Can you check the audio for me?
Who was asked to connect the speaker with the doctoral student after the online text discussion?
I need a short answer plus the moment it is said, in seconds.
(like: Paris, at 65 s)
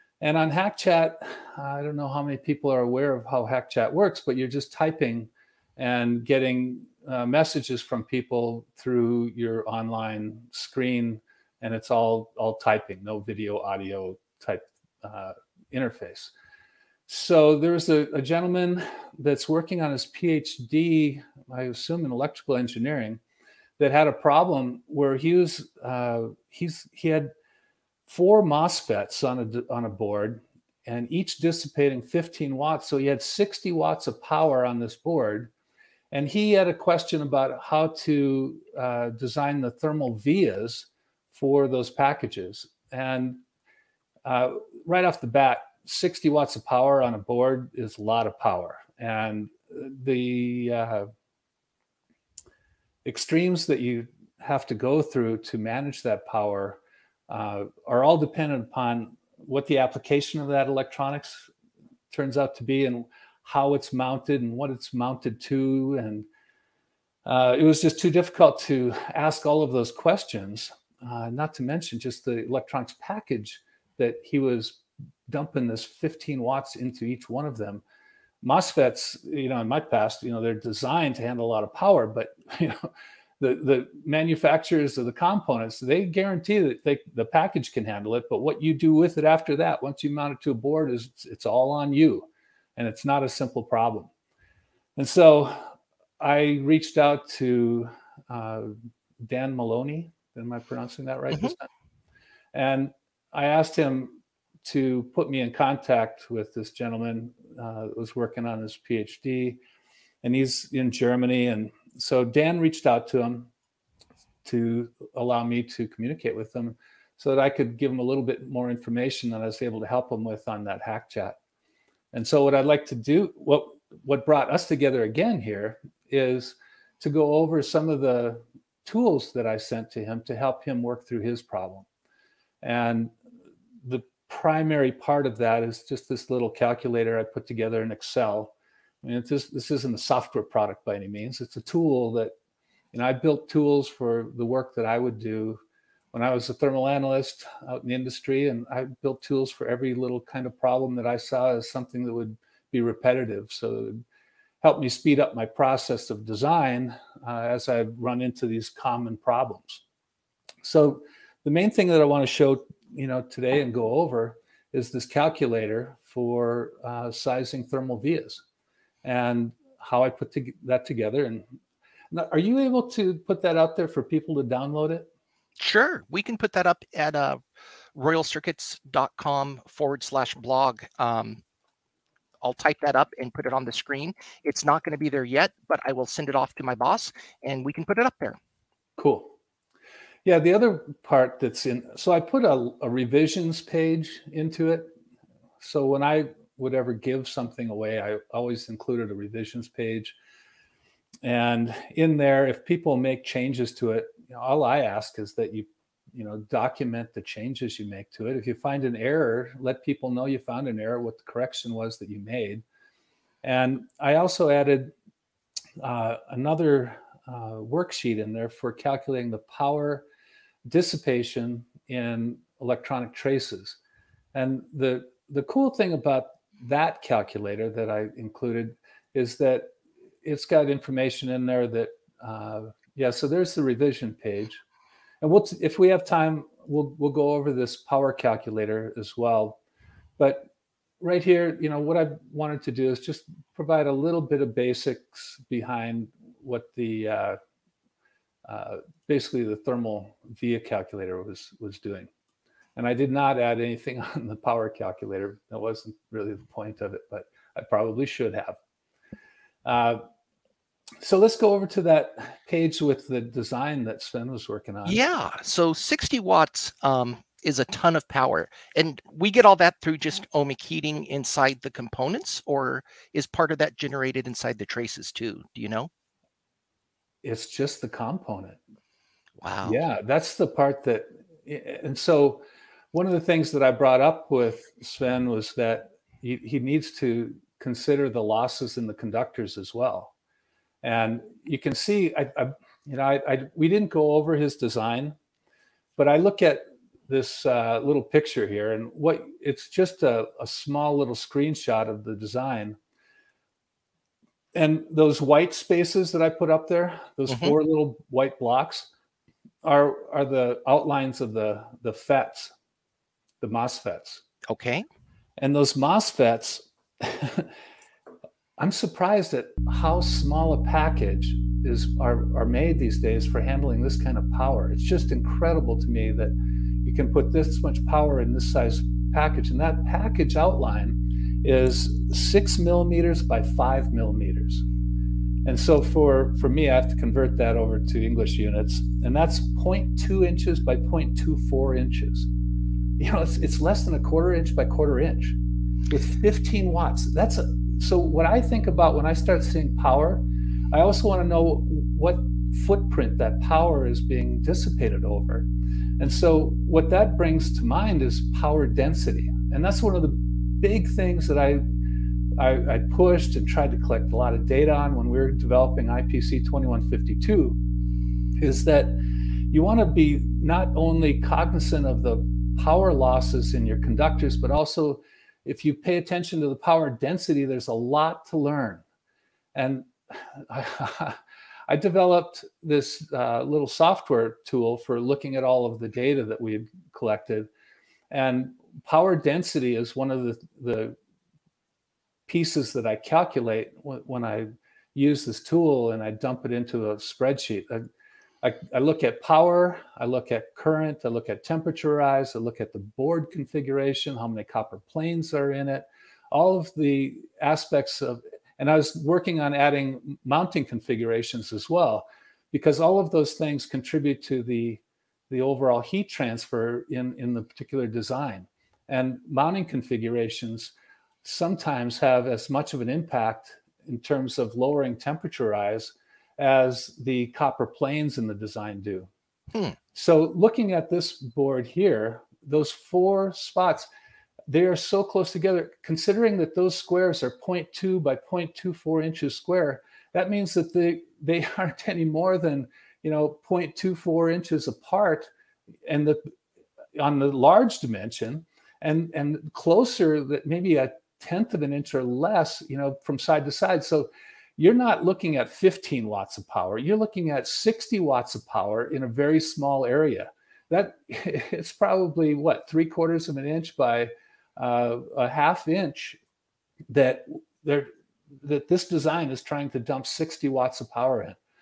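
Dan Maloney, at 99 s.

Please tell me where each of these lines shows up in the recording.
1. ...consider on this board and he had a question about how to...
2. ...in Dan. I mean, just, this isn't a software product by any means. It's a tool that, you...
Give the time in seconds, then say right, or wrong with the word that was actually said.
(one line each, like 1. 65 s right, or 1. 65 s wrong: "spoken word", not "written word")
1. 34 s wrong: "power", not "consider"
2. 137 s wrong: "Excel", not "Dan".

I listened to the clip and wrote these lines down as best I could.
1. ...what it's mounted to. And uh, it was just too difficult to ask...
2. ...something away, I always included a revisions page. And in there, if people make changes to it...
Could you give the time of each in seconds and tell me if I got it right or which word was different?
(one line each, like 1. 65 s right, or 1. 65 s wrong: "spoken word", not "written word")
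1. 64 s right
2. 197 s right.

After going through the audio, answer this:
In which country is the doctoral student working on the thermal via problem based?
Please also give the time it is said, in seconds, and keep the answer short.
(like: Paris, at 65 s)
Germany, at 110 s.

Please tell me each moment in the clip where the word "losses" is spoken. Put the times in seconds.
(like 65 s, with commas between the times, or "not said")
288 s, 372 s.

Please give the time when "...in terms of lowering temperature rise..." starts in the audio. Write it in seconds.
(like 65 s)
423 s.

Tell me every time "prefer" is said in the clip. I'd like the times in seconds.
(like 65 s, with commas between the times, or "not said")
not said.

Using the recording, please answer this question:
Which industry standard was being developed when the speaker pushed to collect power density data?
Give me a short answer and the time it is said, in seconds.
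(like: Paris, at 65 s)
IPC 2152, at 365 s.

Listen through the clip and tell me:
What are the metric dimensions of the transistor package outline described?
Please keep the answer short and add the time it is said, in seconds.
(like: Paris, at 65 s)
6 mm by 5 mm, at 332 s.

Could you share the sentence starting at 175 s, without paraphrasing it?
Sure, we can put that up at uh, royalcircuits.com forward slash blog.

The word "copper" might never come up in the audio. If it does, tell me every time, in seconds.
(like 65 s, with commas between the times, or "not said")
404 s, 427 s.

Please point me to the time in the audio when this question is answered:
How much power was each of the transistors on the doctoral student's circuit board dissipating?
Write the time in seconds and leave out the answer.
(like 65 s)
31 s.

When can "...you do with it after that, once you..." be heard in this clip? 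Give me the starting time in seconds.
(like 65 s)
88 s.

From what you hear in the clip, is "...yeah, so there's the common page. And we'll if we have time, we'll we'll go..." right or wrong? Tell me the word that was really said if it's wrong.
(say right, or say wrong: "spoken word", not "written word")
wrong: "revision", not "common".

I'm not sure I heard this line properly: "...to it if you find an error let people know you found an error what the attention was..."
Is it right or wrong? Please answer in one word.
wrong.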